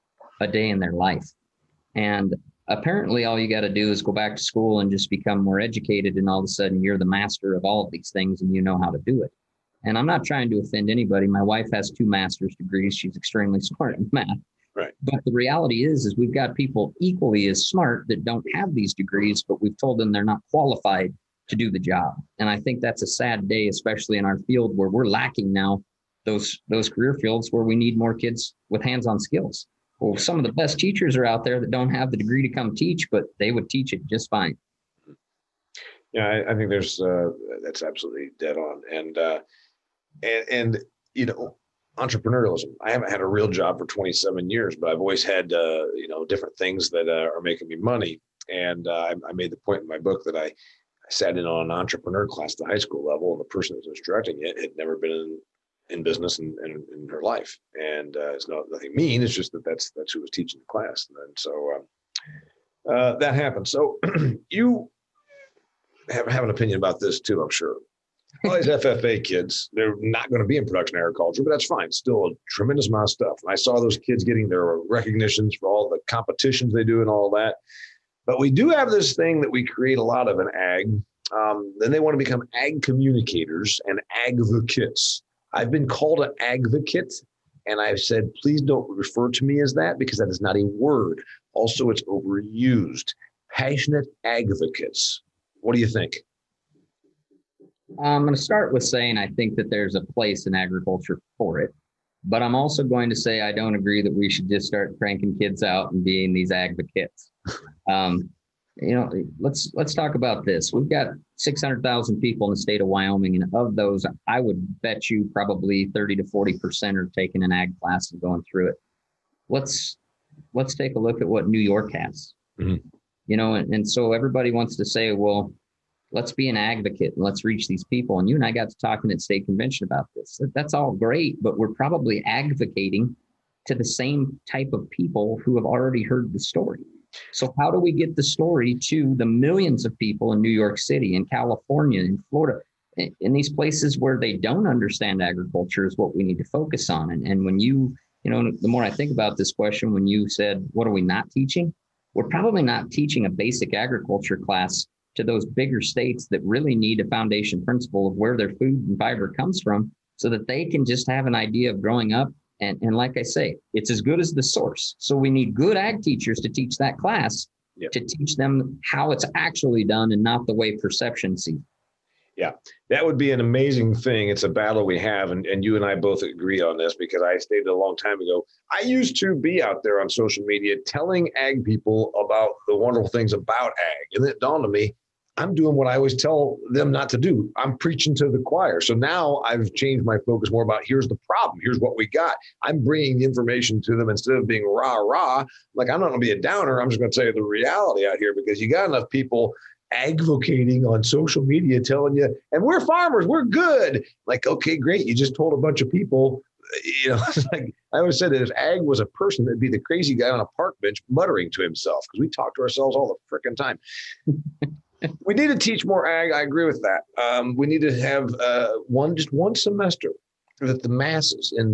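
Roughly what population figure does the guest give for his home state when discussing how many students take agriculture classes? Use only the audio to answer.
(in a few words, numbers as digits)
600,000.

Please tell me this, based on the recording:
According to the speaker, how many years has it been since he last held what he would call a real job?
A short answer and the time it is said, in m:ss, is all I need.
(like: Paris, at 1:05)
27, at 0:43.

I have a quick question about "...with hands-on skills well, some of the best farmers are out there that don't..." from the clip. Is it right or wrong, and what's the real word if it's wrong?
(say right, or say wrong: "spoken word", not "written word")
wrong: "teachers", not "farmers".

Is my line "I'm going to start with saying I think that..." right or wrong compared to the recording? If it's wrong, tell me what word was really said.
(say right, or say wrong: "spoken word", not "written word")
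right.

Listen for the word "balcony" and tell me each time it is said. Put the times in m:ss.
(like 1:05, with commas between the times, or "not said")
not said.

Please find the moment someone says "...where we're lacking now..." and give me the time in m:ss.
0:24.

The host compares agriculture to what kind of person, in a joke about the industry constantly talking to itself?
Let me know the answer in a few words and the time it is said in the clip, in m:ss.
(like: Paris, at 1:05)
crazy guy on a park bench, at 3:29.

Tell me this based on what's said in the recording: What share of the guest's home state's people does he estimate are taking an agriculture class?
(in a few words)
30 to 40 percent.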